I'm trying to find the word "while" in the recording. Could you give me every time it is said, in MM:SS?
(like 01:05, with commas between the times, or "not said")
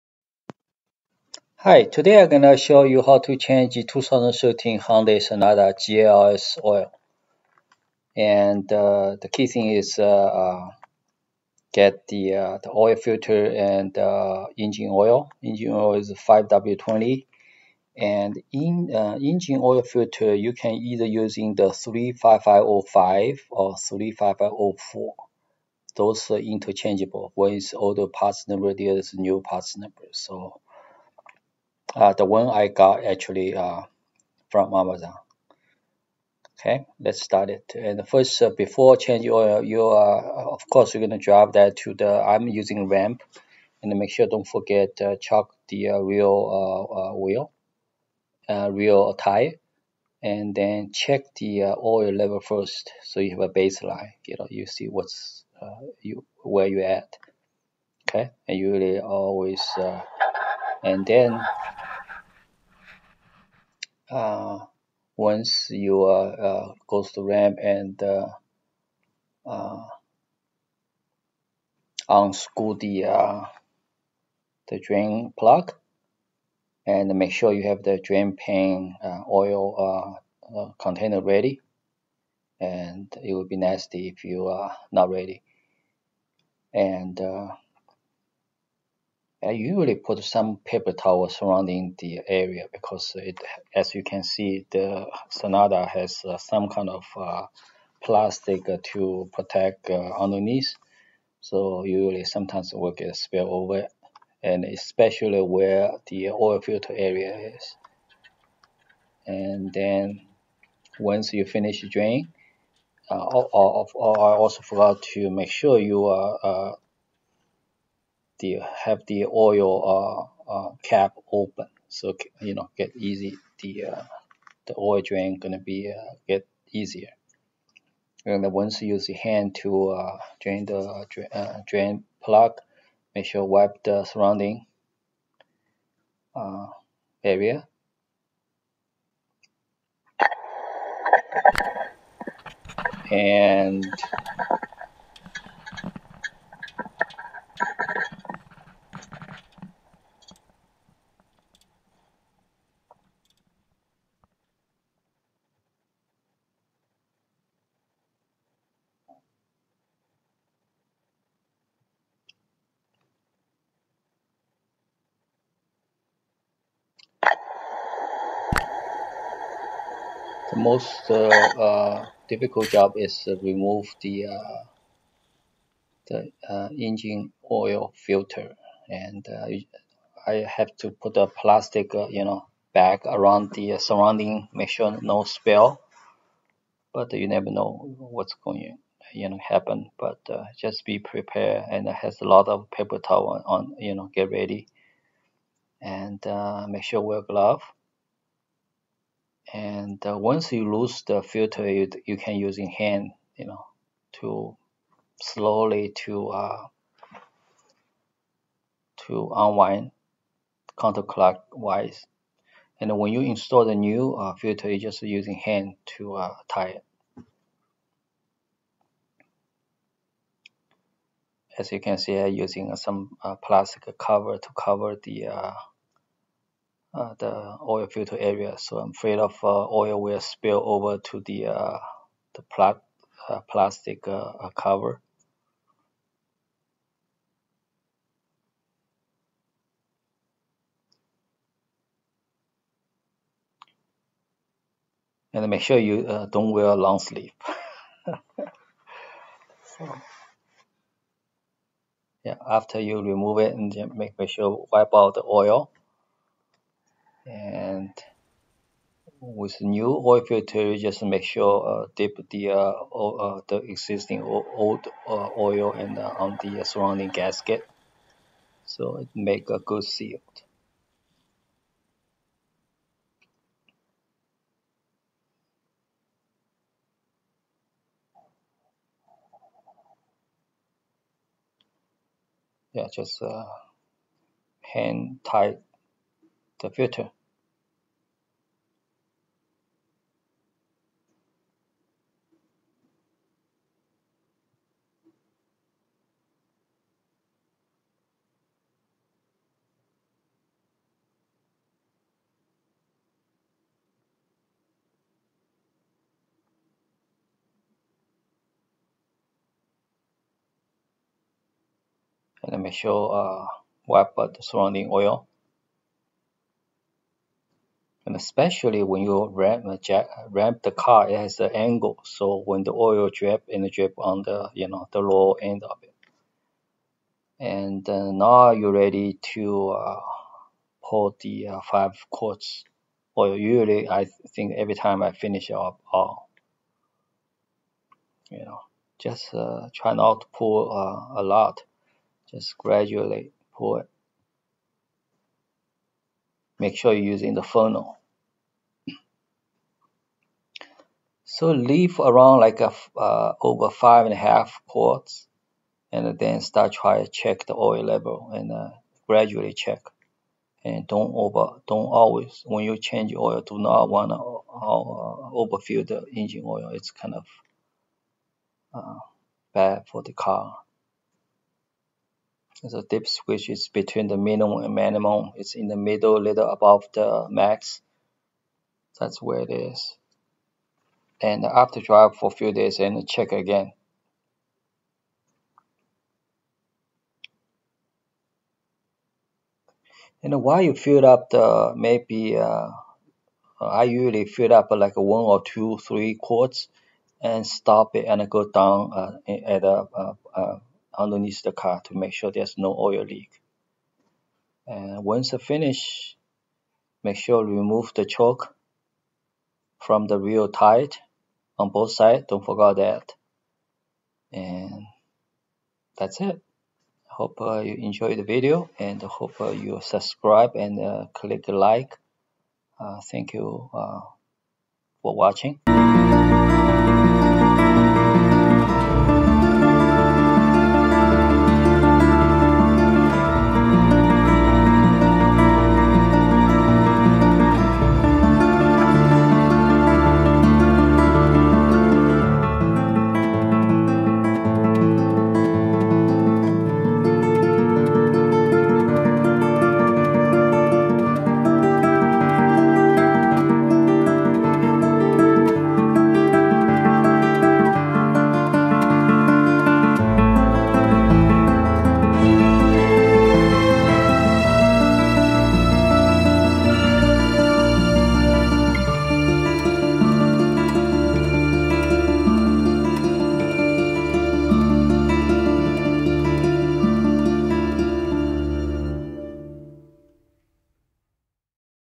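06:30.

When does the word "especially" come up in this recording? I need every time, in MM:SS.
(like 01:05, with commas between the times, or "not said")
01:44, 05:18.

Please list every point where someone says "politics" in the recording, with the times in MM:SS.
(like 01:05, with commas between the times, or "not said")
not said.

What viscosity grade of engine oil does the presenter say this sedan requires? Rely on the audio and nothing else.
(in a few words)
5W20.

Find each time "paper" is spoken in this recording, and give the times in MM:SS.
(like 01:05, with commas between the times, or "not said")
01:30, 03:12.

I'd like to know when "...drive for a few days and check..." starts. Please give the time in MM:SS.
06:21.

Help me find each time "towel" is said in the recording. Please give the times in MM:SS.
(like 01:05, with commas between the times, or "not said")
01:30, 03:12.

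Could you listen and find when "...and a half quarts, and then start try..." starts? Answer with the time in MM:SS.
05:54.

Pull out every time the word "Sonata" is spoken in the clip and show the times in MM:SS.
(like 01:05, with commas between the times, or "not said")
00:05, 01:35.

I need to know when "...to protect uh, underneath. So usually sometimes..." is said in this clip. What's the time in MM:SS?
01:38.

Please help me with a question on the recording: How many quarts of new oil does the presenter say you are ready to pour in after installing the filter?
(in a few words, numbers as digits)
5.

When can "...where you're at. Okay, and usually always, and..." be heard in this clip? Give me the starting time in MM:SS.
00:56.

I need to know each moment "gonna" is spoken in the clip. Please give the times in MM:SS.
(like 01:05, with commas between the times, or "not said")
00:41, 02:05.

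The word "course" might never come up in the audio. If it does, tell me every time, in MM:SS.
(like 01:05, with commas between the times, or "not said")
00:40.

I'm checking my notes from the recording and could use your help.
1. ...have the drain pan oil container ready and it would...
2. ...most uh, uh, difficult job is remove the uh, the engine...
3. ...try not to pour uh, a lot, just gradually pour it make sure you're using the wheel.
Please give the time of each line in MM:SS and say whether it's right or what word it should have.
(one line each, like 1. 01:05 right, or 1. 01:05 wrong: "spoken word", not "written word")
1. 01:17 right
2. 02:50 right
3. 05:39 wrong: "funnel", not "wheel".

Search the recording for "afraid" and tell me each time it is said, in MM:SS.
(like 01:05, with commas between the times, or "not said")
03:48.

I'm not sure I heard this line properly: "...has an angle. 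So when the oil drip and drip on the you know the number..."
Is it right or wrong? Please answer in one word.
wrong.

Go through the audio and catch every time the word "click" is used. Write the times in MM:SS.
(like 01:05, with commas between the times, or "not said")
07:01.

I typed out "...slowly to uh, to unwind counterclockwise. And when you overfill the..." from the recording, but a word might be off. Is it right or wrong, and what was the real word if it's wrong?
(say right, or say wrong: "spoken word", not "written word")
wrong: "install", not "overfill".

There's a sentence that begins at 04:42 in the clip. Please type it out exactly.
Yeah, just uh, hand tight the Wörter.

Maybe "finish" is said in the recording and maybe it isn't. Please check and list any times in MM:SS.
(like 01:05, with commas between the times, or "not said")
01:51, 05:35, 06:45.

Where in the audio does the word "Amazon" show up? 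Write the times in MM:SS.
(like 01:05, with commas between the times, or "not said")
00:34.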